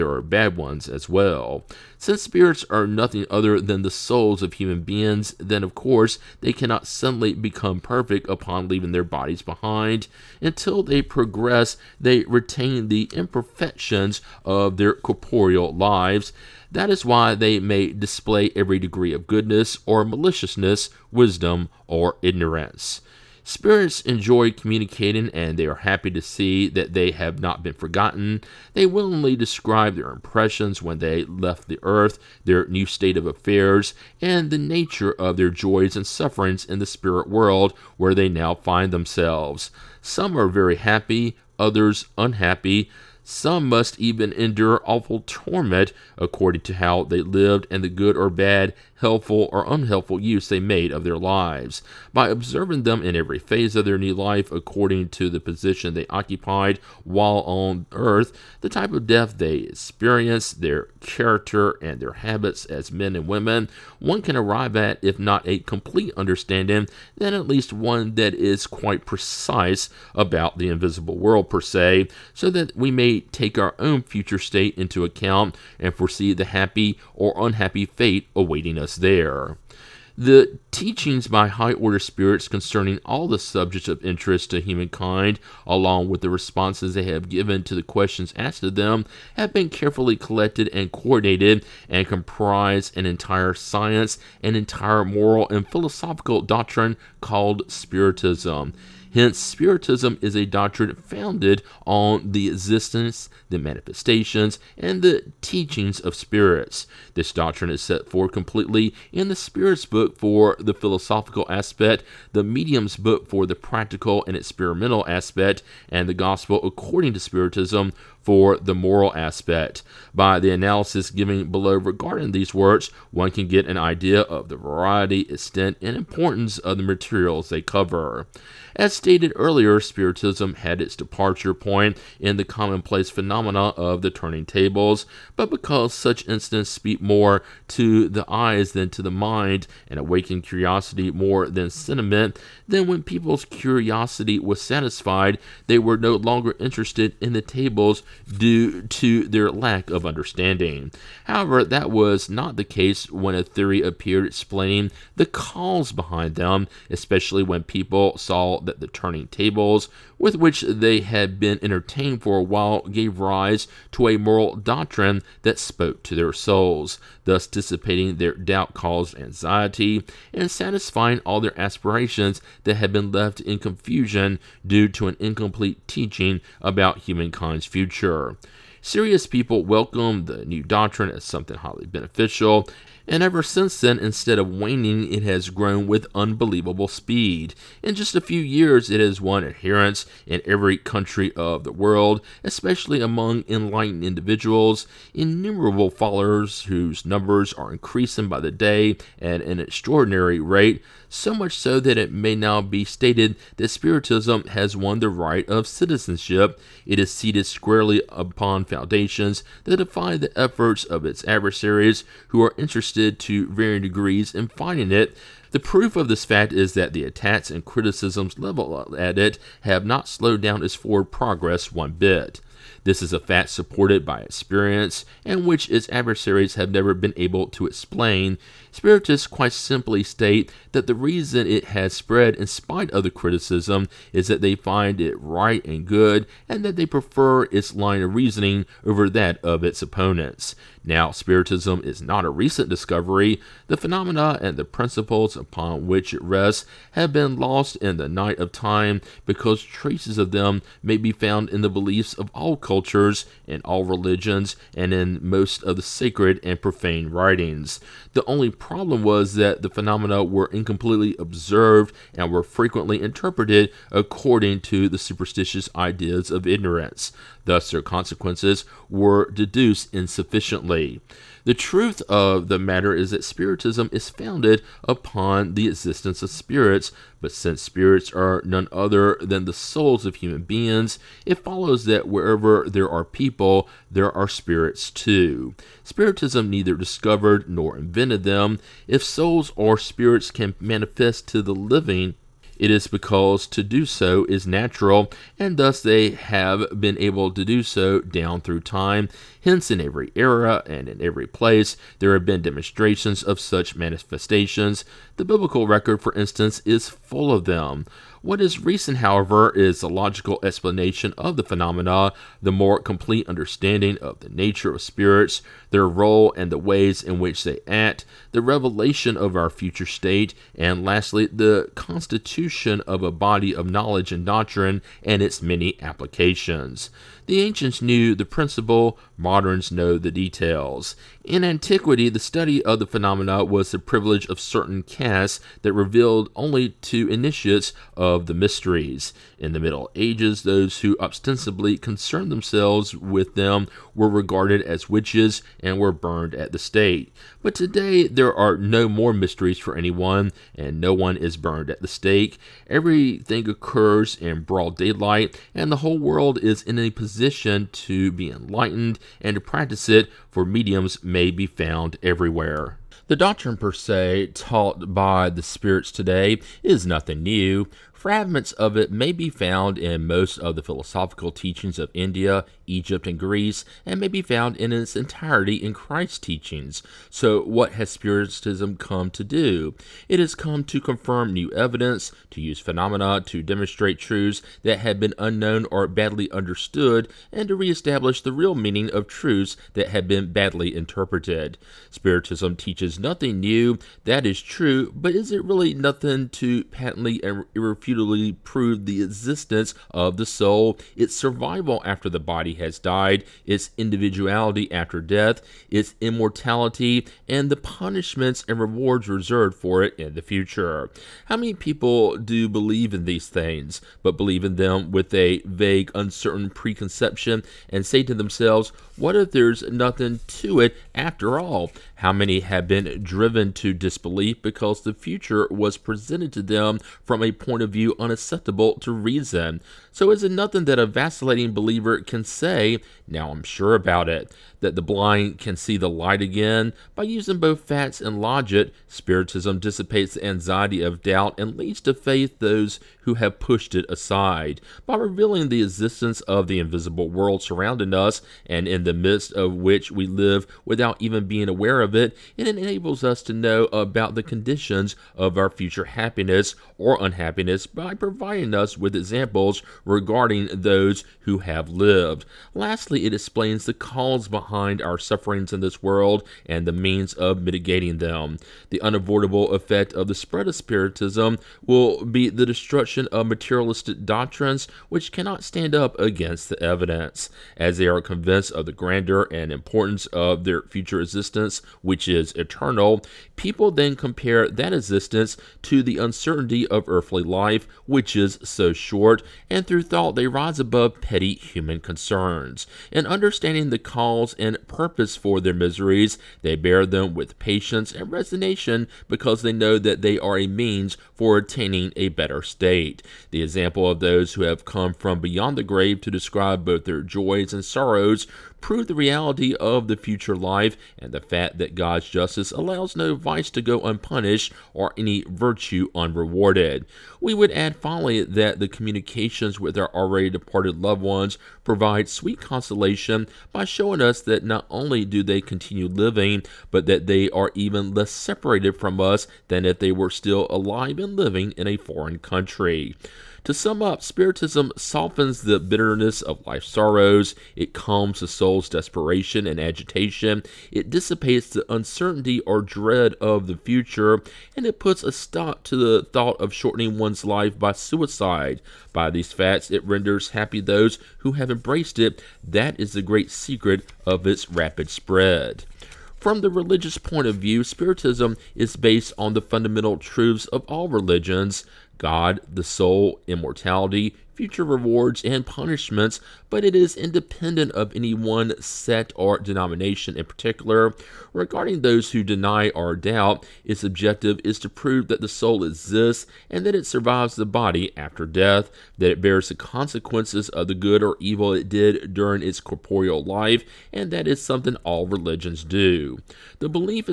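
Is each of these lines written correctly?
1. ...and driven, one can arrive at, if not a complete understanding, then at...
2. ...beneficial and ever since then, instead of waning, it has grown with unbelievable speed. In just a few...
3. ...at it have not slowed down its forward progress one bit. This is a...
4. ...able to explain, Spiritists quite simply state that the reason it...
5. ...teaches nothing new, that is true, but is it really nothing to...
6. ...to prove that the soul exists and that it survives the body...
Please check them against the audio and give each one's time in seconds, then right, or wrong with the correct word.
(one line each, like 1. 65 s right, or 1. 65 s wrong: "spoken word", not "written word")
1. 63 s wrong: "women", not "driven"
2. 181 s right
3. 218 s right
4. 227 s right
5. 392 s right
6. 574 s right.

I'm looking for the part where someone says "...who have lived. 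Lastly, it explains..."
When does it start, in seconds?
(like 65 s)
461 s.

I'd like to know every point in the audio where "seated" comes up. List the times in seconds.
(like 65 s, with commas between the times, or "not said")
207 s.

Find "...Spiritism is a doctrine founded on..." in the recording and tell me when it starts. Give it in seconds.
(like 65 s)
99 s.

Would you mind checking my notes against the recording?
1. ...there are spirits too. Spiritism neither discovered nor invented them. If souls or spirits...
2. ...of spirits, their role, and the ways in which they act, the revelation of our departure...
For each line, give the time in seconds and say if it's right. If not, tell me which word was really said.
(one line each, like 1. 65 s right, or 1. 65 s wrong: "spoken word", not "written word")
1. 283 s right
2. 314 s wrong: "future", not "departure".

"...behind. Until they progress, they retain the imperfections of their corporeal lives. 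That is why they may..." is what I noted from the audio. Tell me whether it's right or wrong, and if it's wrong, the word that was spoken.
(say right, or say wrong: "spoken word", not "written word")
right.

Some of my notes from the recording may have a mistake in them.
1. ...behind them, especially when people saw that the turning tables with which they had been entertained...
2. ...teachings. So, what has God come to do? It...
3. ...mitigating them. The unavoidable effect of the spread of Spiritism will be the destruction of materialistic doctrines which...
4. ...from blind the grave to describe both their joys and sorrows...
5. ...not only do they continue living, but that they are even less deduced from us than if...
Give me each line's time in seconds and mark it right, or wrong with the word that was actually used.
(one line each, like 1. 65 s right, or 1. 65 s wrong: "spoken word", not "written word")
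1. 155 s right
2. 376 s wrong: "Spiritism", not "God"
3. 467 s right
4. 504 s wrong: "beyond", not "blind"
5. 524 s wrong: "separated", not "deduced".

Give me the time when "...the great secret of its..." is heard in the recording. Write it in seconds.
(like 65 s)
552 s.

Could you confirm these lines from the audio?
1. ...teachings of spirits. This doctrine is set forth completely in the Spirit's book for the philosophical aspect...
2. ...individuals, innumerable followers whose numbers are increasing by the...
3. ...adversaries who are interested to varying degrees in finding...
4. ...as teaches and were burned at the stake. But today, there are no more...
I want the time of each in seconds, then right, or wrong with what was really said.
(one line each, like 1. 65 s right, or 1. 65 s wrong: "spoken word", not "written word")
1. 105 s right
2. 194 s right
3. 211 s right
4. 344 s wrong: "witches", not "teaches".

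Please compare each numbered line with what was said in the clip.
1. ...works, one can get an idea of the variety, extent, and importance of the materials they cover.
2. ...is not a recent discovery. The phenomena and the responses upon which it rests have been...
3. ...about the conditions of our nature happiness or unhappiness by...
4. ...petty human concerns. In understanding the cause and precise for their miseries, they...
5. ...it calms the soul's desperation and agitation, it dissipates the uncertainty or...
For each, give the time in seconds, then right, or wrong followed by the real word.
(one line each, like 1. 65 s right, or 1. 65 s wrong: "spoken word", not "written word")
1. 122 s right
2. 241 s wrong: "principles", not "responses"
3. 453 s wrong: "future", not "nature"
4. 490 s wrong: "purpose", not "precise"
5. 537 s right.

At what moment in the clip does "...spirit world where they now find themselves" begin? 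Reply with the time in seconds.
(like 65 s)
36 s.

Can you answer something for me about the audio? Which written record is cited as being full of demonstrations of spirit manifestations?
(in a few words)
The biblical record.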